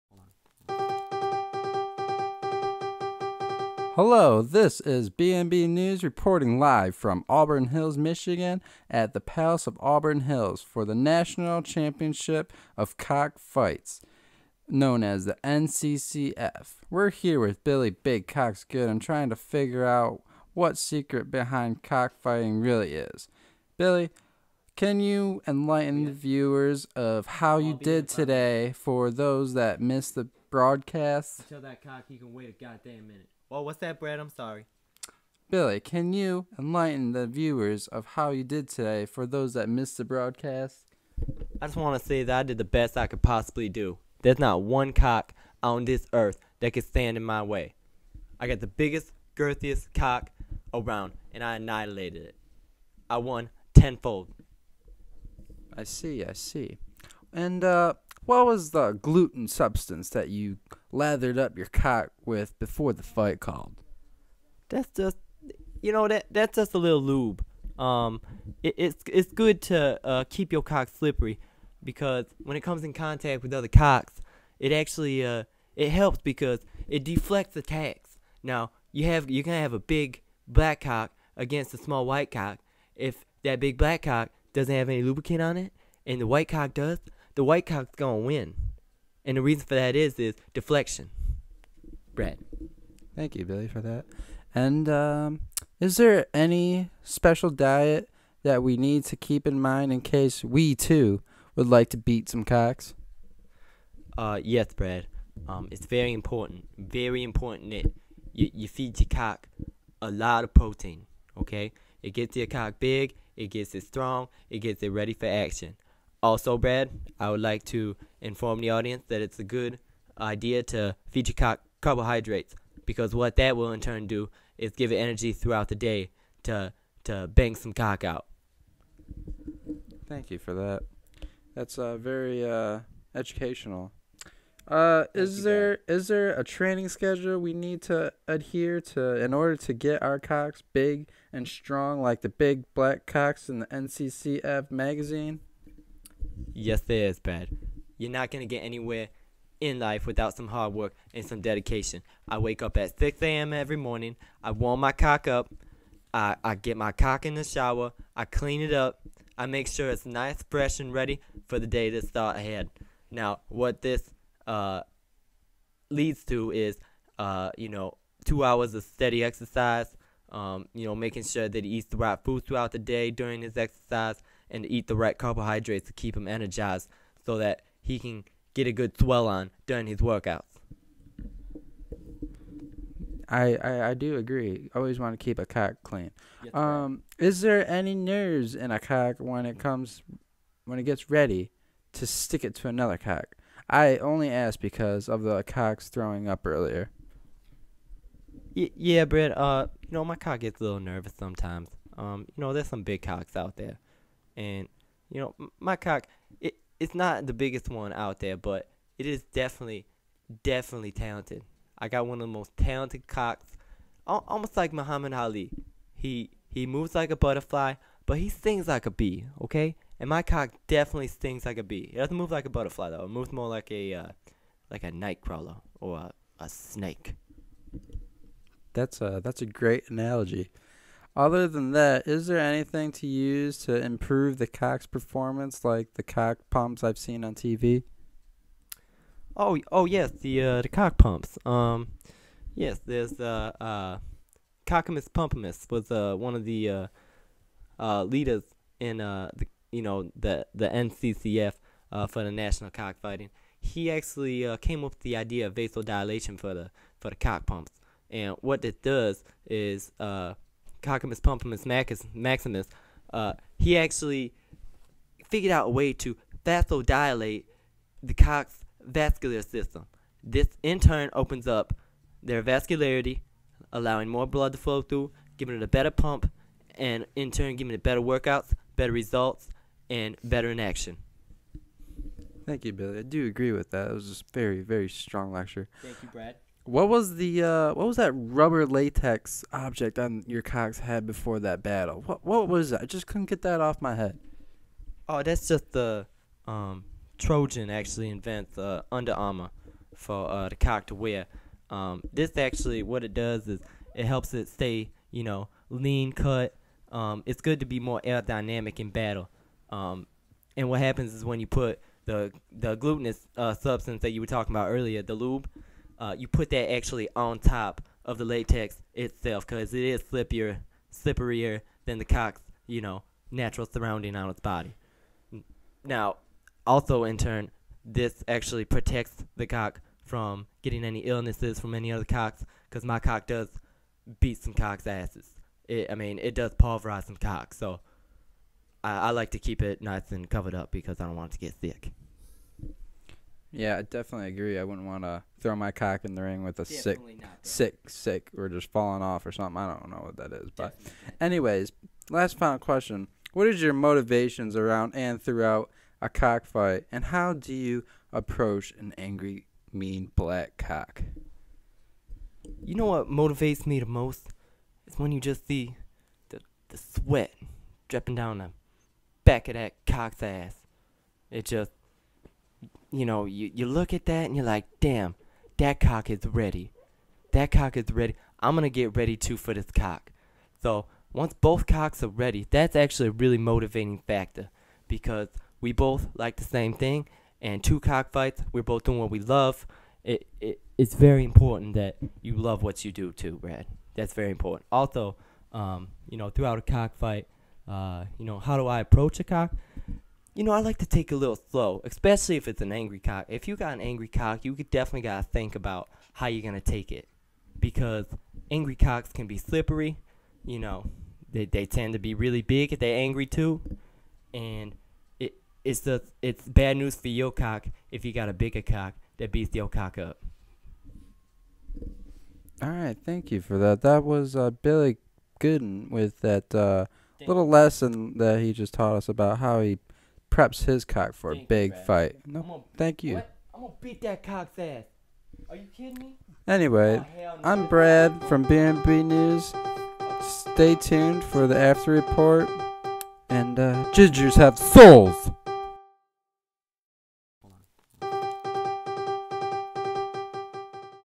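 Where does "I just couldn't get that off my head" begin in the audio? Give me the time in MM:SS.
04:52.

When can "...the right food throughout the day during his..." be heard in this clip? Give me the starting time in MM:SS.
02:51.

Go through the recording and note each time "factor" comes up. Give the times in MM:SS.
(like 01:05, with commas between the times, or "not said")
06:23.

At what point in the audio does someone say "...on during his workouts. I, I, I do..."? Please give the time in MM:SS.
02:59.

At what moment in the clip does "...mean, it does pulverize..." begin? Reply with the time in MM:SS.
05:35.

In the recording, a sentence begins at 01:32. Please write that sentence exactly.
Brad, thank you, Billy, for that.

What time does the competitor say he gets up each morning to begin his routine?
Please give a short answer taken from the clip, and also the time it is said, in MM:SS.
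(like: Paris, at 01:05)
6 a.m., at 02:32.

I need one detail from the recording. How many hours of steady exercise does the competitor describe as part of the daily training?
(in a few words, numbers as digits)
2.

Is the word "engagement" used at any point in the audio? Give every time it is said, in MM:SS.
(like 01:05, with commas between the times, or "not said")
not said.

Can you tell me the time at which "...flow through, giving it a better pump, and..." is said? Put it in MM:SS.
04:34.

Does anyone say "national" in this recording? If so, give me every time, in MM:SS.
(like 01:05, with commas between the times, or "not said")
00:10, 04:12.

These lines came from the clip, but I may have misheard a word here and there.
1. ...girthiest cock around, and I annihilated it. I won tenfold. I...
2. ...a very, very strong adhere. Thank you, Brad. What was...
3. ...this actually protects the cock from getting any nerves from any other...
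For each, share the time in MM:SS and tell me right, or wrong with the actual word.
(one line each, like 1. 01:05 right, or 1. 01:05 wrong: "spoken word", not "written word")
1. 00:49 right
2. 04:44 wrong: "lecture", not "adhere"
3. 05:27 wrong: "illnesses", not "nerves".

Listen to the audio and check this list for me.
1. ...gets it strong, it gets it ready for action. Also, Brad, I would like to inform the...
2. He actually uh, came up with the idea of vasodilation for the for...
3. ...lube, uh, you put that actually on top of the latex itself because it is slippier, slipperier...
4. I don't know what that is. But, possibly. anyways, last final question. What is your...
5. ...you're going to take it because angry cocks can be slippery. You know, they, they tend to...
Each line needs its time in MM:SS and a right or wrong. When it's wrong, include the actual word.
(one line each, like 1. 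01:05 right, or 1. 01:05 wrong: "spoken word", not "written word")
1. 01:53 right
2. 04:13 right
3. 05:15 right
4. 05:49 wrong: "definitely", not "possibly"
5. 06:46 right.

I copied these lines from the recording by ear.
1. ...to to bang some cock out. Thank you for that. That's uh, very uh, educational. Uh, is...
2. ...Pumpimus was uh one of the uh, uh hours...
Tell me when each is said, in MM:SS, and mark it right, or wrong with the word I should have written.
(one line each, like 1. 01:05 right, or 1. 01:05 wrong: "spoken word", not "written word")
1. 02:06 right
2. 04:05 wrong: "leaders", not "hours".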